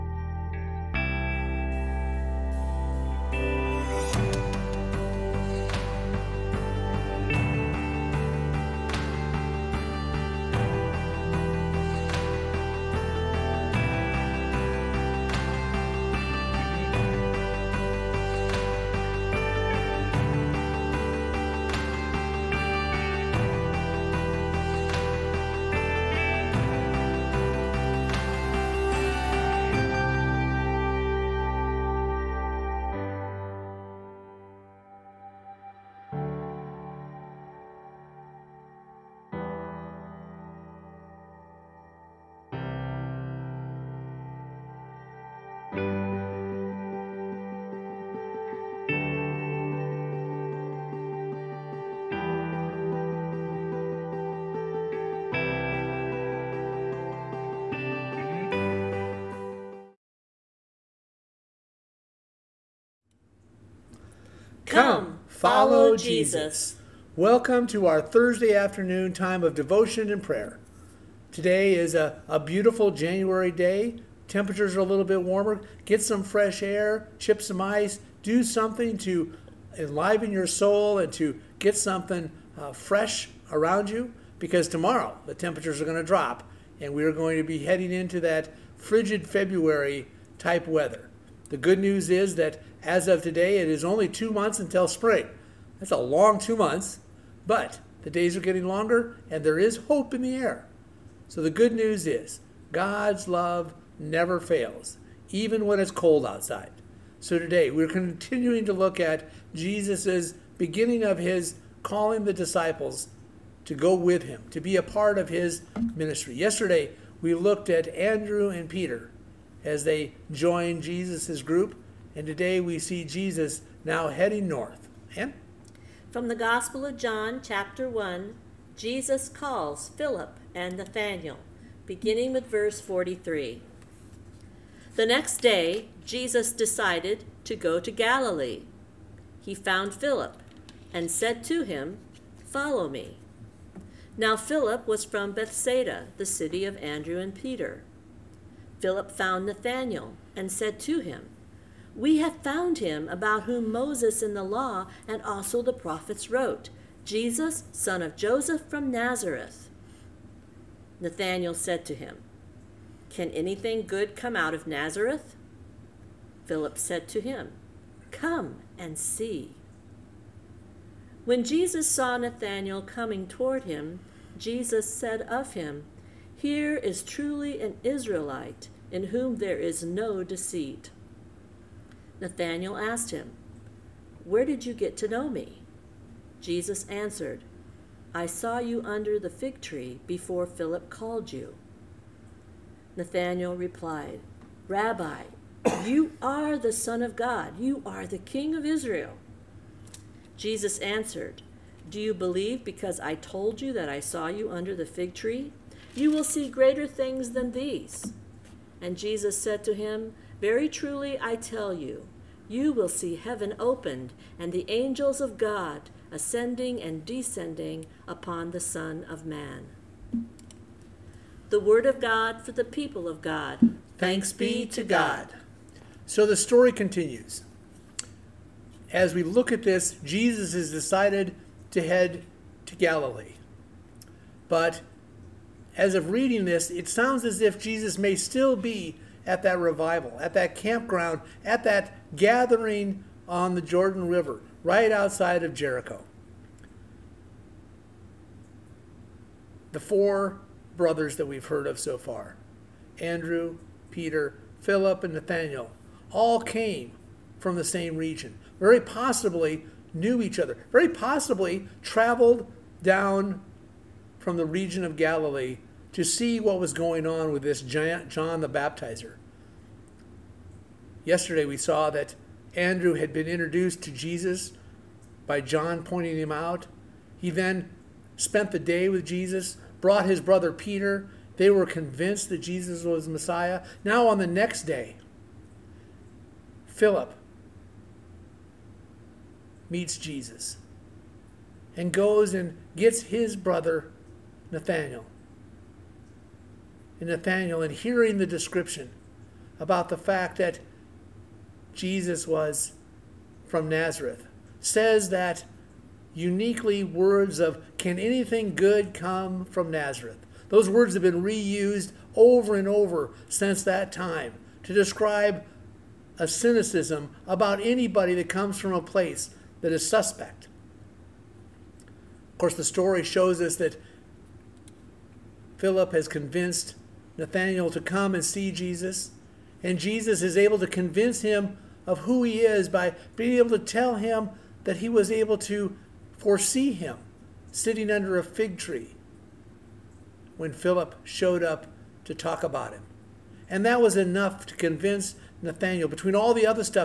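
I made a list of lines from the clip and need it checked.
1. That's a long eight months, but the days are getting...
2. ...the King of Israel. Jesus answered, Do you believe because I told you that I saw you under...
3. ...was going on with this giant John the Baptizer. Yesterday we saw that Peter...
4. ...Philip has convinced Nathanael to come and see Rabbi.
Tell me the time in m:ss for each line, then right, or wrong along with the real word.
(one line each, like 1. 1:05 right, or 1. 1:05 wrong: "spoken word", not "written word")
1. 1:35 wrong: "two", not "eight"
2. 3:18 right
3. 4:26 wrong: "Andrew", not "Peter"
4. 5:25 wrong: "Jesus", not "Rabbi".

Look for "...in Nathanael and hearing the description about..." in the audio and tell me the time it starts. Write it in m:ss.
4:57.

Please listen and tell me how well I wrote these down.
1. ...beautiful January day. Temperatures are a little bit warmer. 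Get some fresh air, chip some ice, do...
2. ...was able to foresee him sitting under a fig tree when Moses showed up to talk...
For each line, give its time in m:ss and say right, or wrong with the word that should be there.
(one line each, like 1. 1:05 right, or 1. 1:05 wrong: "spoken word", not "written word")
1. 1:12 right
2. 5:34 wrong: "Philip", not "Moses".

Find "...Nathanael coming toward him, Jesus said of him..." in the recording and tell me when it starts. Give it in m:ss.
2:52.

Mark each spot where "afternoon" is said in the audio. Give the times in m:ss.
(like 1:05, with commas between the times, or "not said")
1:08.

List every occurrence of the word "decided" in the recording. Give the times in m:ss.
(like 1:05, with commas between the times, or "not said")
2:16, 3:50.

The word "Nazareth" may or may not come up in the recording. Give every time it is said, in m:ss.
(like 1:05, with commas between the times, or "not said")
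2:38, 2:44, 5:03, 5:09.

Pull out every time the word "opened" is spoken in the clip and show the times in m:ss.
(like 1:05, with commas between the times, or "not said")
3:33.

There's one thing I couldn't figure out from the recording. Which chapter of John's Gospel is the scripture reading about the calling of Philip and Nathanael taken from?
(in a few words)
Chapter 1.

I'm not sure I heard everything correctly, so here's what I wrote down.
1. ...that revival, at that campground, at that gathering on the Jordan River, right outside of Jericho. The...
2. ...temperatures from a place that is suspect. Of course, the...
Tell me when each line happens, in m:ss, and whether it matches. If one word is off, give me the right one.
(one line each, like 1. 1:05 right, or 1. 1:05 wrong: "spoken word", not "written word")
1. 3:59 right
2. 5:18 wrong: "comes", not "temperatures".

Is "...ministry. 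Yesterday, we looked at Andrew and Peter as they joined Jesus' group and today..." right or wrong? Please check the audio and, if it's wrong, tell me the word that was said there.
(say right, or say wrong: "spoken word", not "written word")
right.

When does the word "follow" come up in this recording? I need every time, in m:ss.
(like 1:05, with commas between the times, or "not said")
1:05, 2:22.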